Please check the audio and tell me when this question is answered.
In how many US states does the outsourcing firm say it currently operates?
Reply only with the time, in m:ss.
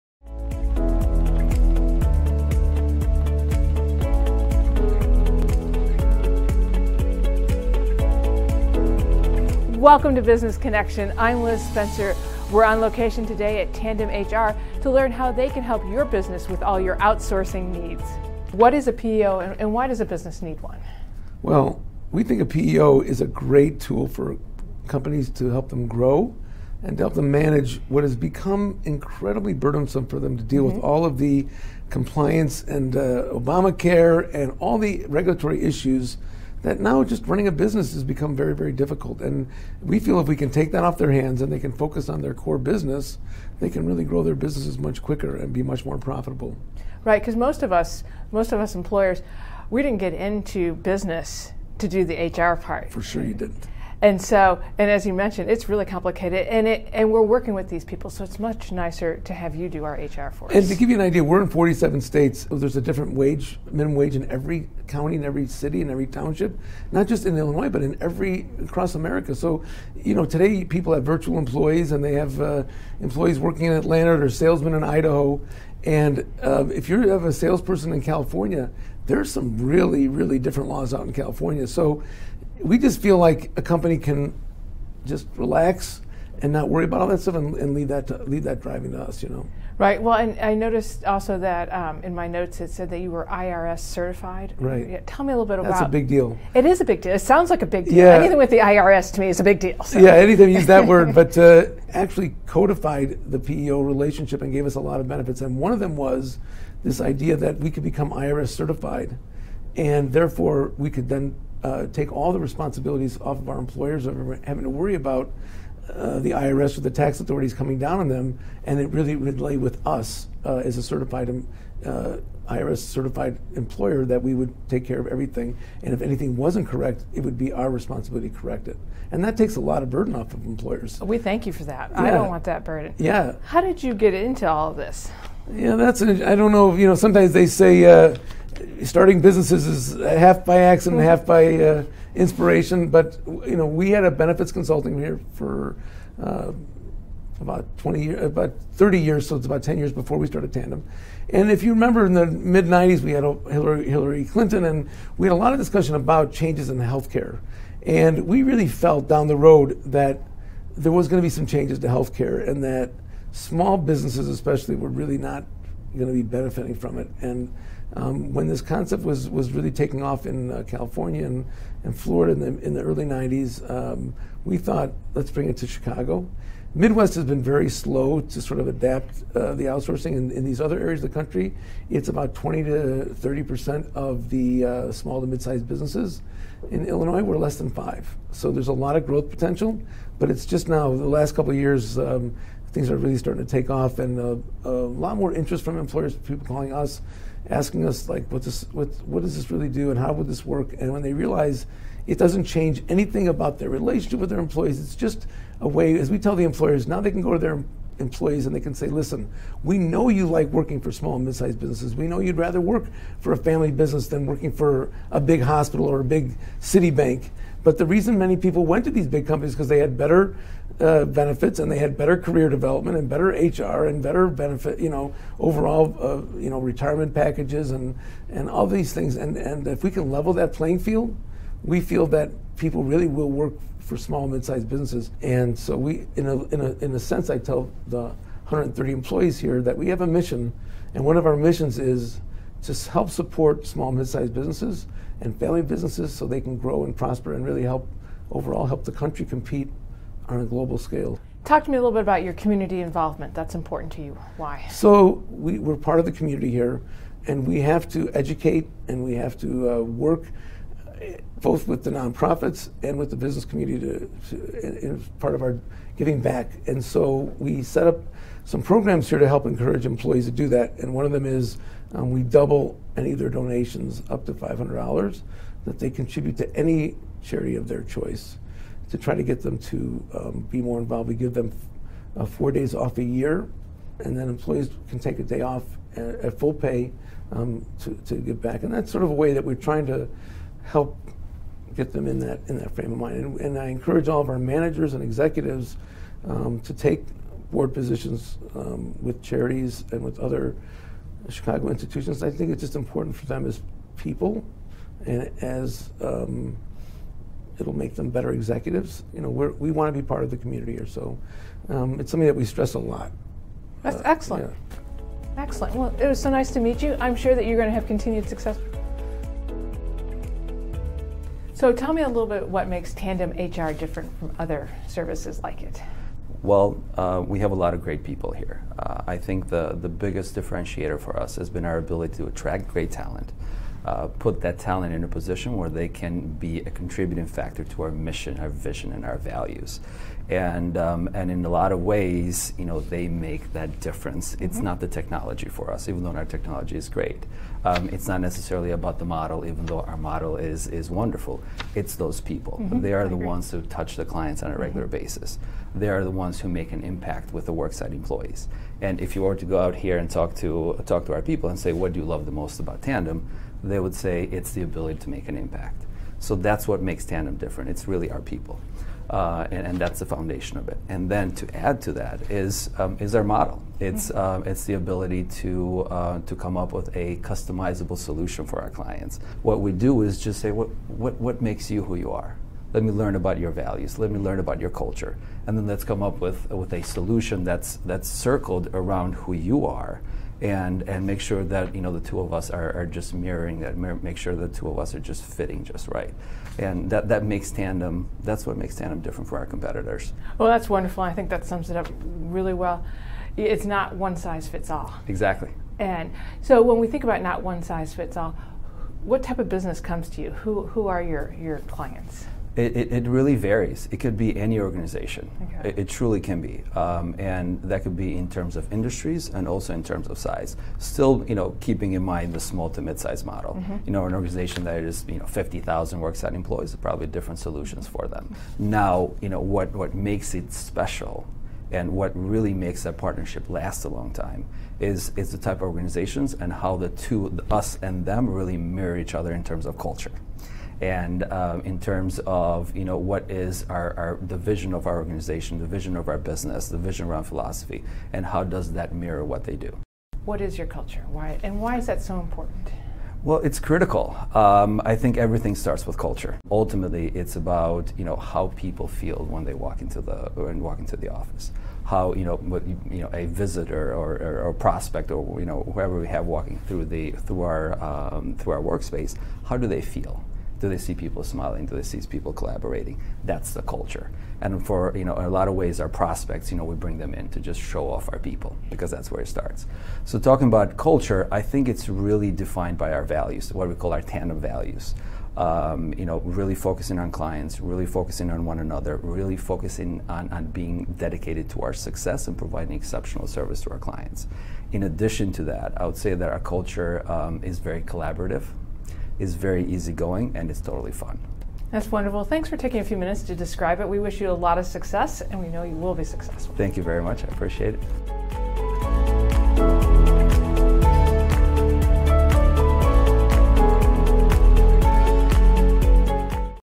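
1:01.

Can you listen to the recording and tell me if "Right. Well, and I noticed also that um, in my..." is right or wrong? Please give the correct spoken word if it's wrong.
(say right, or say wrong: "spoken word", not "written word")
right.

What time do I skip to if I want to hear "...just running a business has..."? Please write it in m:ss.
0:37.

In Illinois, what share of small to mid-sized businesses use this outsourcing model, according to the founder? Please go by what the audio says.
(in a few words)
less than 5 percent.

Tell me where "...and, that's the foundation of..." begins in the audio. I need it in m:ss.
6:09.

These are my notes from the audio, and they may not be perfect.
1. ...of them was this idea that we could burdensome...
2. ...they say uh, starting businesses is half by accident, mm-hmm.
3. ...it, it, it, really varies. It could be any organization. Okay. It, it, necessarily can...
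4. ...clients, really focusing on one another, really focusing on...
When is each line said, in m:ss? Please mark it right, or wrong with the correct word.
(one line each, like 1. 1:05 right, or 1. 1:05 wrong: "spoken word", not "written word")
1. 1:45 wrong: "become", not "burdensome"
2. 2:17 right
3. 6:52 wrong: "truly", not "necessarily"
4. 8:07 right.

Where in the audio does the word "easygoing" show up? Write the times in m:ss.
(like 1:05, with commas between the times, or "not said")
8:19.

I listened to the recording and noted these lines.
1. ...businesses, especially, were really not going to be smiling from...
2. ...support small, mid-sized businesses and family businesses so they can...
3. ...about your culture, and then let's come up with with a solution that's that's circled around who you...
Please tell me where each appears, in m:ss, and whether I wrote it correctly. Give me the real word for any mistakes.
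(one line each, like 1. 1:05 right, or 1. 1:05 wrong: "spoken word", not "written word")
1. 2:43 wrong: "benefiting", not "smiling"
2. 4:03 right
3. 6:24 right.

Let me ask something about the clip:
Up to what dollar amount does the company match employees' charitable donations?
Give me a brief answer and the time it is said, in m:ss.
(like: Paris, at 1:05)
$500, at 4:34.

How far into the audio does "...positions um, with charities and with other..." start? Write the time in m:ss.
4:57.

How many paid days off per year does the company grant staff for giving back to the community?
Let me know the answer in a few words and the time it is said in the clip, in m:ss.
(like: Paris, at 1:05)
4, at 4:42.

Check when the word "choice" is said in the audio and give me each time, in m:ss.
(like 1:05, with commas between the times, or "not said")
4:37.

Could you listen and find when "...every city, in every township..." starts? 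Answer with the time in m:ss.
1:05.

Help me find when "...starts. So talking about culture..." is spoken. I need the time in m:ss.
7:59.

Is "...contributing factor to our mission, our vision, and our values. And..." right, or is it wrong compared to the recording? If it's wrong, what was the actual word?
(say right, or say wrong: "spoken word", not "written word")
right.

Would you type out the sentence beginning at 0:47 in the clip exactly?
Right, because most of us, most of us employers, we didn't get into business to do the HR part.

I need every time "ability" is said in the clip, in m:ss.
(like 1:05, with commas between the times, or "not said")
5:31, 6:04, 6:14.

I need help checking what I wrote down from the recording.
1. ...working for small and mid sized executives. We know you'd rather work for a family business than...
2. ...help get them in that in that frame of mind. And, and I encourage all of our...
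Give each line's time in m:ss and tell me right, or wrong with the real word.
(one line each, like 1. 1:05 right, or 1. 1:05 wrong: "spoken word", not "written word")
1. 3:30 wrong: "businesses", not "executives"
2. 4:50 right.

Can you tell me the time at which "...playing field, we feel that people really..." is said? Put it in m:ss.
3:50.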